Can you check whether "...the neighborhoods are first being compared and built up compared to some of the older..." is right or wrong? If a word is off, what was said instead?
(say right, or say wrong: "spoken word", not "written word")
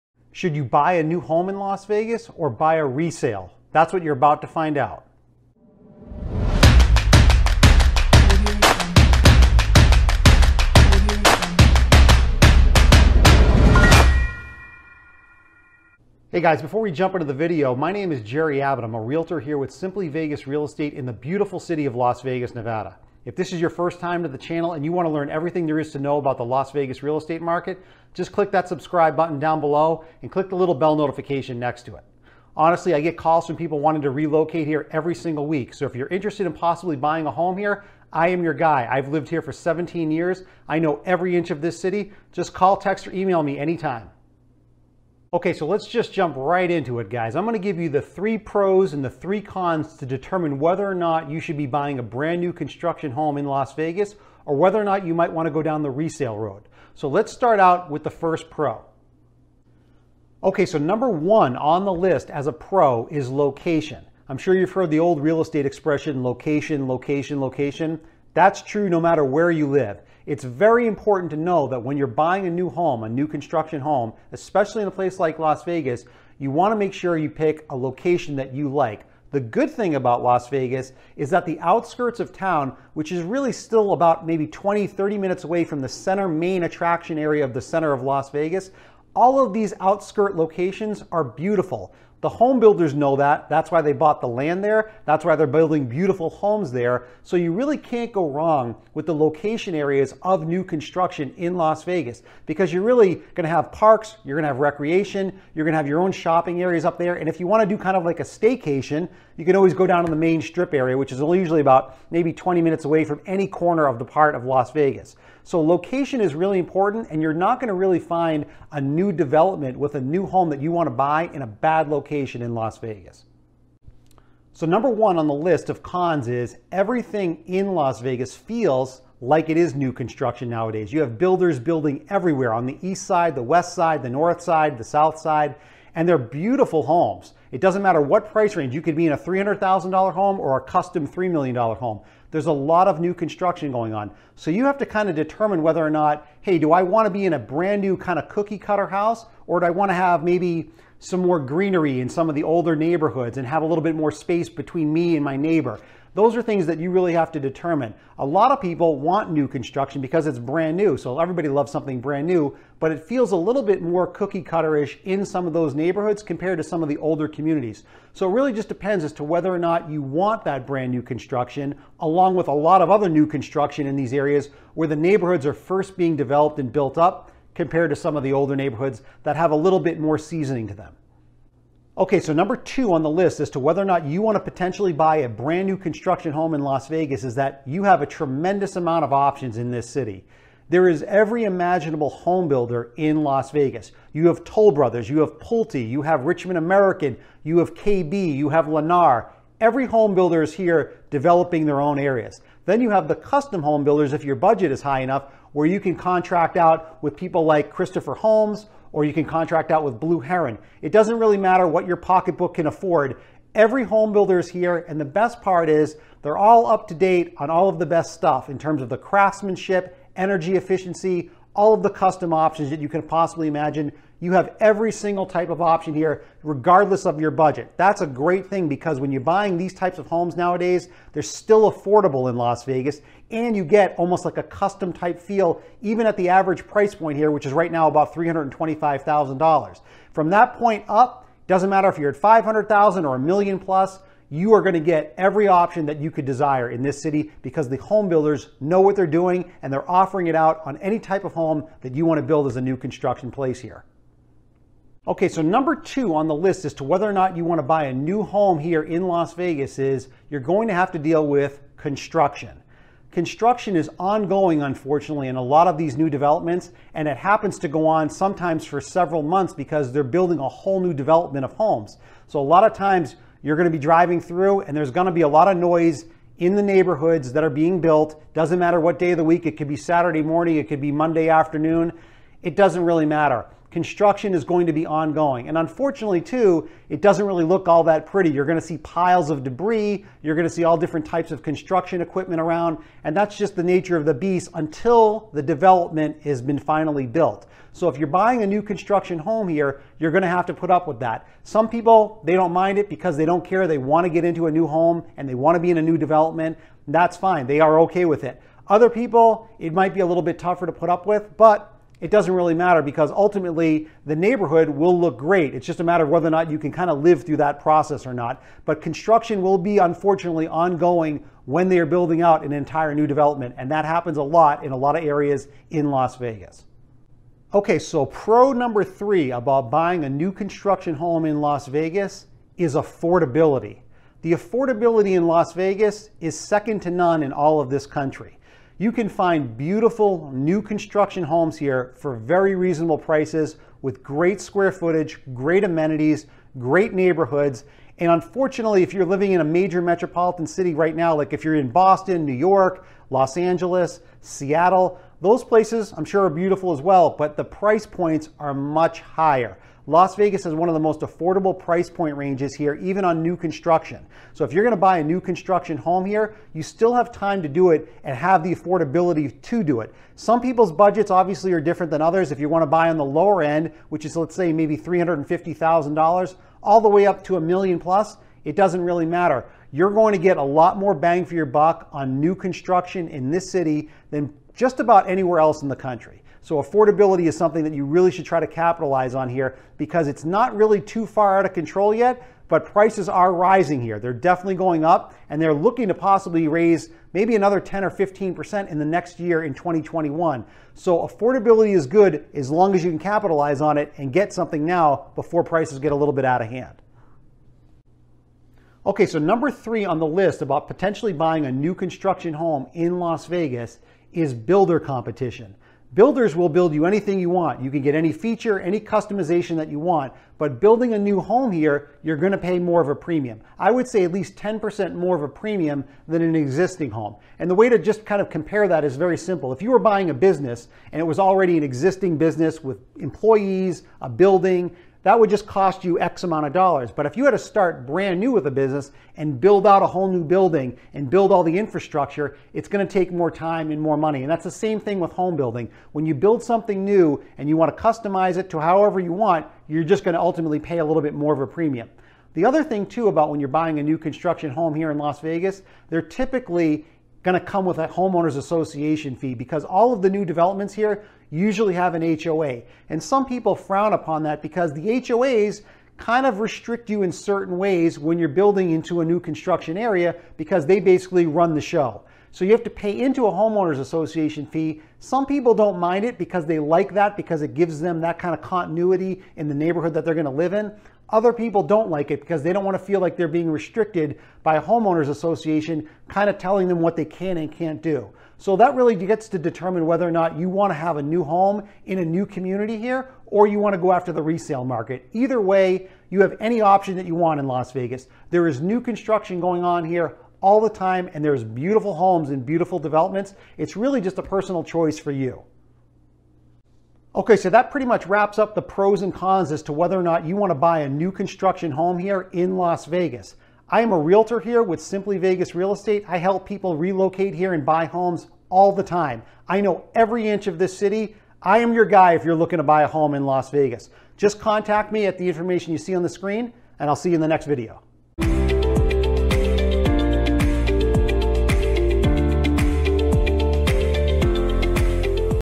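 wrong: "developed", not "compared".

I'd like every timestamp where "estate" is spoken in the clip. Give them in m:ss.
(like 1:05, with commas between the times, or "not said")
0:20, 0:27, 1:05, 8:35.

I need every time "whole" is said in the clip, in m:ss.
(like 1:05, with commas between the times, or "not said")
4:30, 7:19.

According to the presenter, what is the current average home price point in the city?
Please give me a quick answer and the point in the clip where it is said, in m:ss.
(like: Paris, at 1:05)
$325,000, at 3:58.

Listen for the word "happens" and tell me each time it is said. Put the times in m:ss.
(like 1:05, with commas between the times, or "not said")
4:27, 5:23.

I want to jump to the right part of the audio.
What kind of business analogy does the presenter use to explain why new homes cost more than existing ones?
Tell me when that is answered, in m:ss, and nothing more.
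7:09.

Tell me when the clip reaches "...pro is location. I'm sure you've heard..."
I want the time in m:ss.
1:02.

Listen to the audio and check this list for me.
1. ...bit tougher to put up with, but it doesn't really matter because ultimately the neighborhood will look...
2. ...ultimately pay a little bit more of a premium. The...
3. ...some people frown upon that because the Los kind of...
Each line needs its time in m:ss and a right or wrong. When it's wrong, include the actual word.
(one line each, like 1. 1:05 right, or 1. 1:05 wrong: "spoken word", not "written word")
1. 5:10 right
2. 7:30 right
3. 7:43 wrong: "HOAs", not "Los".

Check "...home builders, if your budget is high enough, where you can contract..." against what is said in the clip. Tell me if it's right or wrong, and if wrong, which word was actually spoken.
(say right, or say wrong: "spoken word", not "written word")
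right.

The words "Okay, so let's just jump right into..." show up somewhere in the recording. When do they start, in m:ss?
0:45.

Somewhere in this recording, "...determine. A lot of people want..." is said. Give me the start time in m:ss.
2:37.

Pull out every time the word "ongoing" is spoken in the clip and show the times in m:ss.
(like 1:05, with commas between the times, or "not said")
4:23, 4:44, 5:20.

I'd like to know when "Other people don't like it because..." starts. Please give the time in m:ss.
8:01.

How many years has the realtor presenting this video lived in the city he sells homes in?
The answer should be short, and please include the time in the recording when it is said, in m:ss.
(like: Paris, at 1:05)
17, at 0:39.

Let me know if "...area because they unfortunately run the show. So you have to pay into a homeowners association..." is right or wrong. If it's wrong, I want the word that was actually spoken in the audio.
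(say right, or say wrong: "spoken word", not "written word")
wrong: "basically", not "unfortunately".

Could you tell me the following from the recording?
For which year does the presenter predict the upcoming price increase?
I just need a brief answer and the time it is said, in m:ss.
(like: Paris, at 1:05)
2021, at 6:39.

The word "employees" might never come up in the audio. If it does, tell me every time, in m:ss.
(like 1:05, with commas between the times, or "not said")
7:12.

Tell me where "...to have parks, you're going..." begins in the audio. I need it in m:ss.
1:43.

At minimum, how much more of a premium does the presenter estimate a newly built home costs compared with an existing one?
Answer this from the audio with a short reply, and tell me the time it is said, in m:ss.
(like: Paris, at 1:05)
10%, at 7:04.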